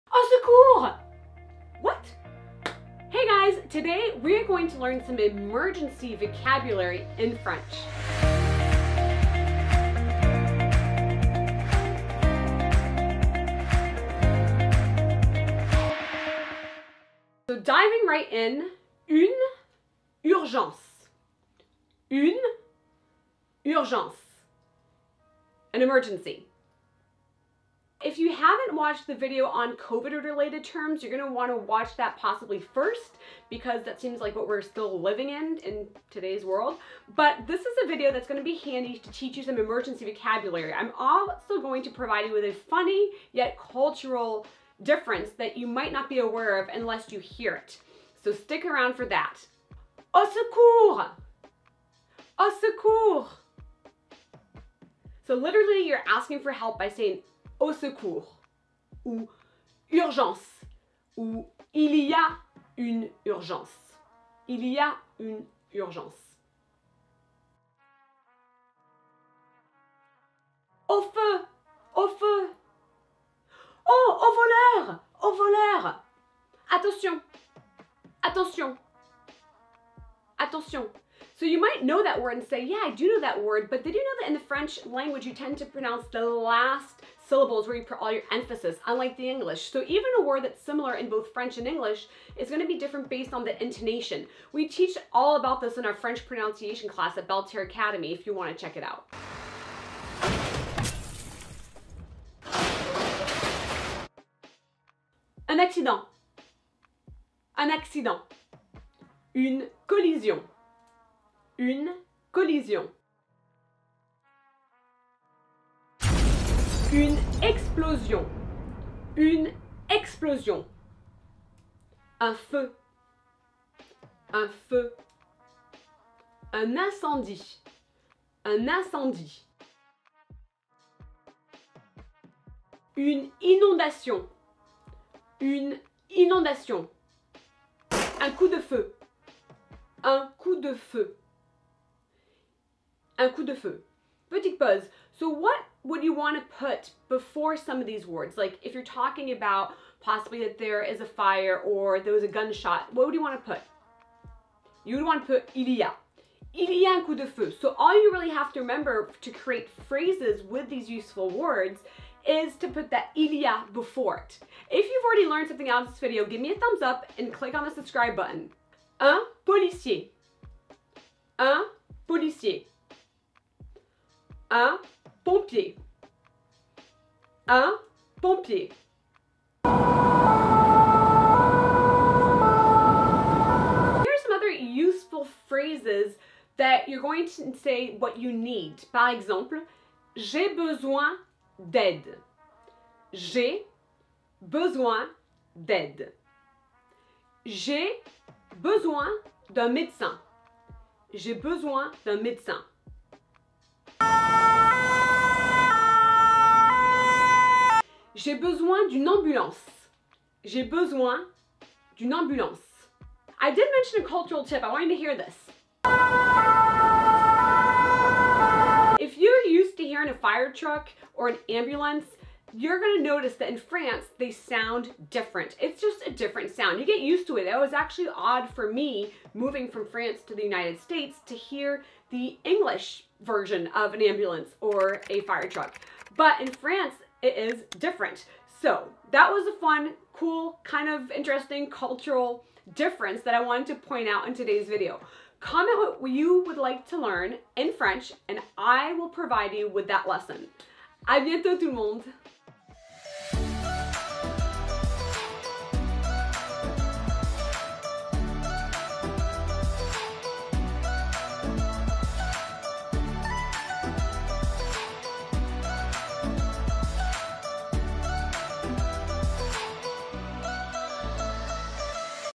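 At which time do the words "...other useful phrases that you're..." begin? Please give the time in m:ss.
3:04.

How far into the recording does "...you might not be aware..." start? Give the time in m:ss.
0:45.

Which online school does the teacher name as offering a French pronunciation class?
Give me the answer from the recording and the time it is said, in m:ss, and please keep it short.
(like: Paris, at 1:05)
Belle Terre Academy, at 1:37.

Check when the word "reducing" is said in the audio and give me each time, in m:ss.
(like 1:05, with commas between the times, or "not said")
not said.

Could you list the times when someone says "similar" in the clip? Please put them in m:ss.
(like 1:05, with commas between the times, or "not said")
1:30.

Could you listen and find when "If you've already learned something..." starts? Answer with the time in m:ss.
2:44.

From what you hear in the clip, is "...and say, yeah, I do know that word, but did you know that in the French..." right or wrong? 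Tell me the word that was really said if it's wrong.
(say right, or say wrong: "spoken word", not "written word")
right.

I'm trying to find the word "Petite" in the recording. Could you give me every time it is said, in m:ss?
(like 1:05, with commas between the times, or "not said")
2:24.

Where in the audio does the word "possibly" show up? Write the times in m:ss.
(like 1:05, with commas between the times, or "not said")
0:32, 2:29.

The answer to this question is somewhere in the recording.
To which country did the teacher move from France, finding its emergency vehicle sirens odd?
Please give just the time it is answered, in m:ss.
3:50.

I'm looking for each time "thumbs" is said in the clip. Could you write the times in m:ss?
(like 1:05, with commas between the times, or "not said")
2:46.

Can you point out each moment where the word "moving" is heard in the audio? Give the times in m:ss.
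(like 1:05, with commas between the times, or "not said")
3:49.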